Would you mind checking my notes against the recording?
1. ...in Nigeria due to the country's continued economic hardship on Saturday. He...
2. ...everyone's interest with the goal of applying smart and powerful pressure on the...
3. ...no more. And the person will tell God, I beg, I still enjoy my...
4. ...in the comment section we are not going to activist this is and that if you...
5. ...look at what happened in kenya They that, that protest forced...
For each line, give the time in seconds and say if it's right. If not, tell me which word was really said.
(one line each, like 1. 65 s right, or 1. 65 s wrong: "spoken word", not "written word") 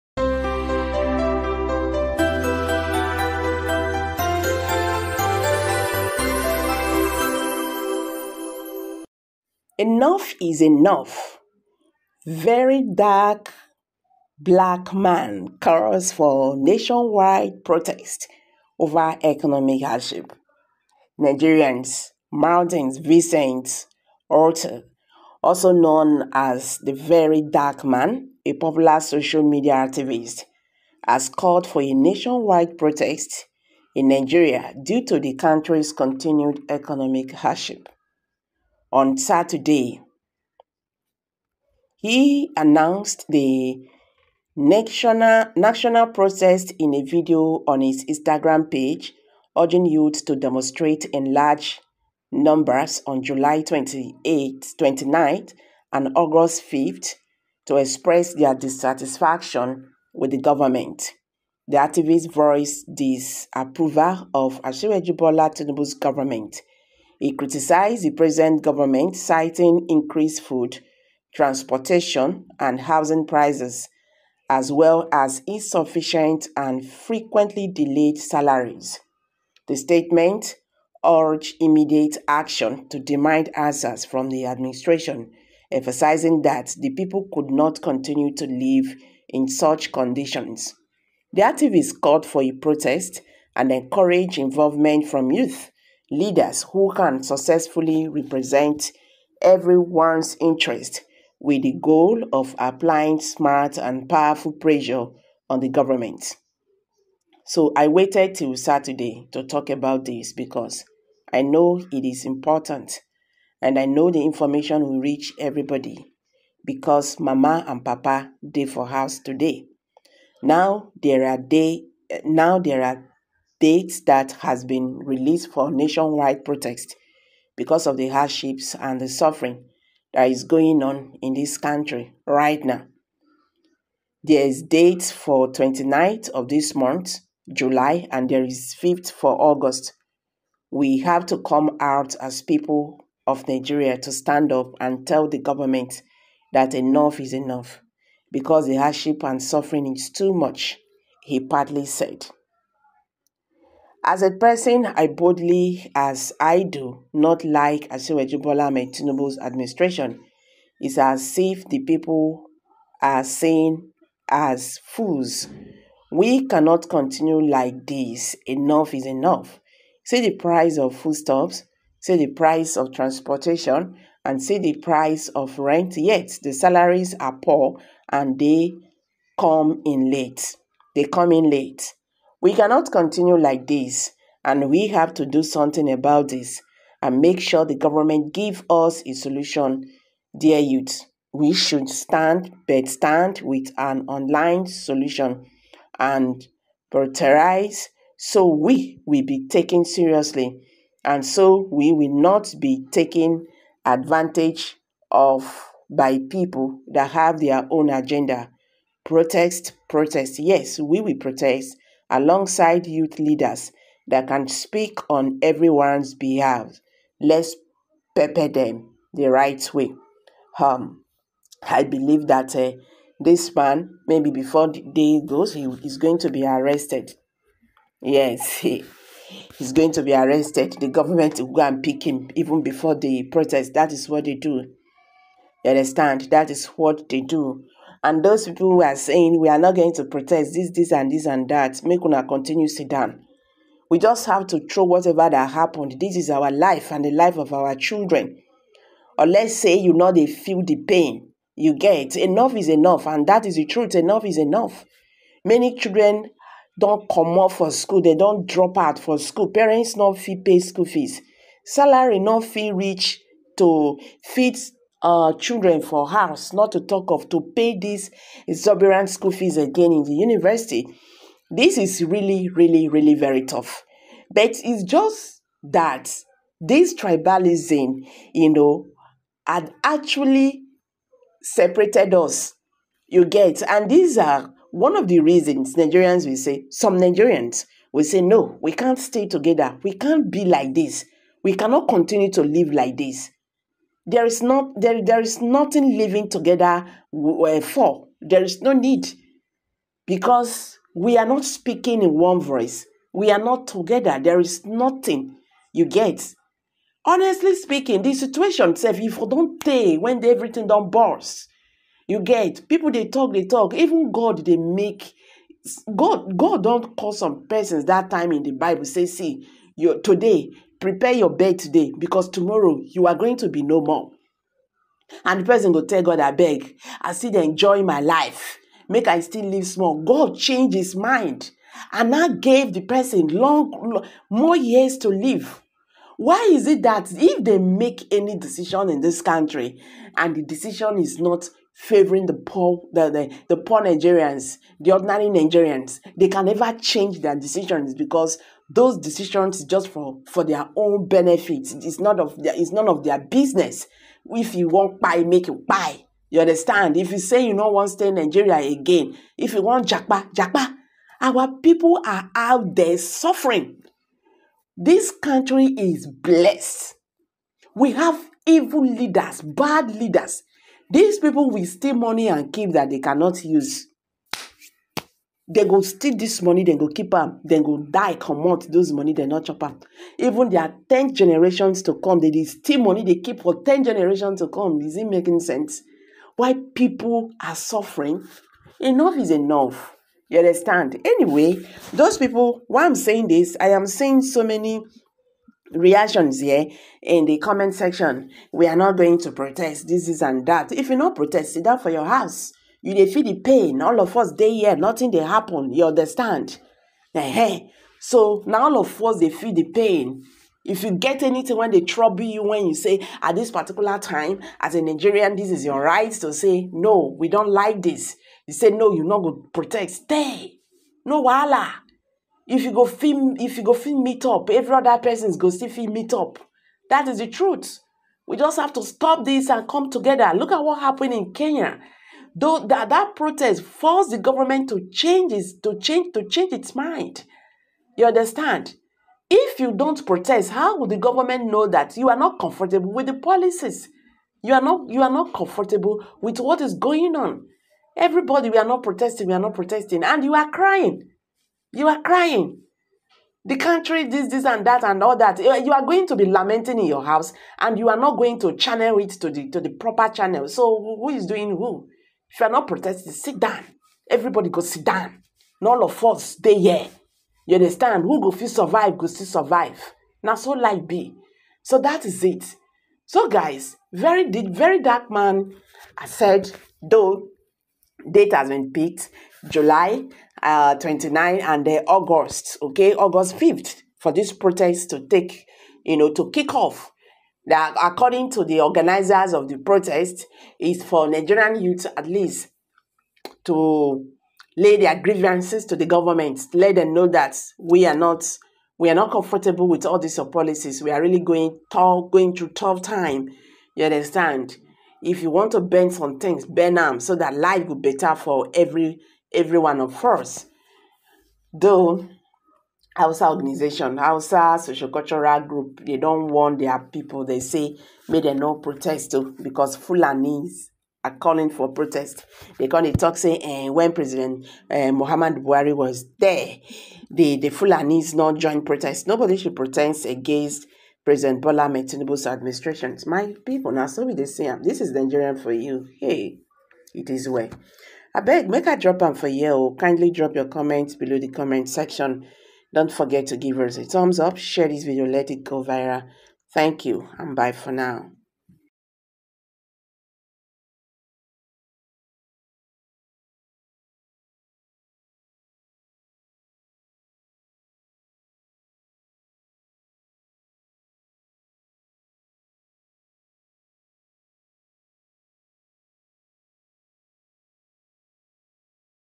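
1. 33 s right
2. 99 s right
3. 323 s right
4. 397 s wrong: "protest", not "activist"
5. 430 s wrong: "Though", not "They".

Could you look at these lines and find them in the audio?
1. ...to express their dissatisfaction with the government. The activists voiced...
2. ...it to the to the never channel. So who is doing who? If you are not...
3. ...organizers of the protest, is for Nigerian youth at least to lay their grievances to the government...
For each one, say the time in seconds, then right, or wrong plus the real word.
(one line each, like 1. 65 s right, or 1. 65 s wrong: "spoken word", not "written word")
1. 57 s right
2. 458 s wrong: "proper", not "never"
3. 488 s right.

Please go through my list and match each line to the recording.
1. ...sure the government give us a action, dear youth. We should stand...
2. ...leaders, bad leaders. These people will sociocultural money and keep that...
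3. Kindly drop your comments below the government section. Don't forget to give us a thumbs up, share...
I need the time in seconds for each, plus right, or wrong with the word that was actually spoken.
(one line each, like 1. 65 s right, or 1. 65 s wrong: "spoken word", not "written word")
1. 187 s wrong: "solution", not "action"
2. 368 s wrong: "steal", not "sociocultural"
3. 539 s wrong: "comment", not "government".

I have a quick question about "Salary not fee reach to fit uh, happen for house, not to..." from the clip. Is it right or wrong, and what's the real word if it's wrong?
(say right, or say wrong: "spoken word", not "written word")
wrong: "children", not "happen".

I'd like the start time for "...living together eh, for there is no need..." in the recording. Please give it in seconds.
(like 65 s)
295 s.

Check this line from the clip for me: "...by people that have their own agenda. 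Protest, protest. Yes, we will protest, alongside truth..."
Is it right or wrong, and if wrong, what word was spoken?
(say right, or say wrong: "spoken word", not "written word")
wrong: "youth", not "truth".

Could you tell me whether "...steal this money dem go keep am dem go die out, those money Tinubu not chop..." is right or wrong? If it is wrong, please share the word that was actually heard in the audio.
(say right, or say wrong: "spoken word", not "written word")
wrong: "They", not "Tinubu".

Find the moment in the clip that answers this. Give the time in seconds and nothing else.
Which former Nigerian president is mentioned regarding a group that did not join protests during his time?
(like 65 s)
524 s.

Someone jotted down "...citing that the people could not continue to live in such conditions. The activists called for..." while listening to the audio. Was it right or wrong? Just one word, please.
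wrong.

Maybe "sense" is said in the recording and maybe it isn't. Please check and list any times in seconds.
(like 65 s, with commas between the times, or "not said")
385 s.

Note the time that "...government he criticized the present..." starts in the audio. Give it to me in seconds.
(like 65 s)
65 s.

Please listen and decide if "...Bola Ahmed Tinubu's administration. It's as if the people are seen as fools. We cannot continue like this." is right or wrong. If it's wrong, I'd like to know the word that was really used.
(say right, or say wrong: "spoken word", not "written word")
right.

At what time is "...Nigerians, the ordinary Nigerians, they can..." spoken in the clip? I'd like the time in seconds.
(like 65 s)
343 s.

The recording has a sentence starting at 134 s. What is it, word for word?
There is date for 29th of this month, July, and there is 5th for August.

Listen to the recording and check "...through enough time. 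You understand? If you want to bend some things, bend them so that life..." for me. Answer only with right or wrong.
wrong.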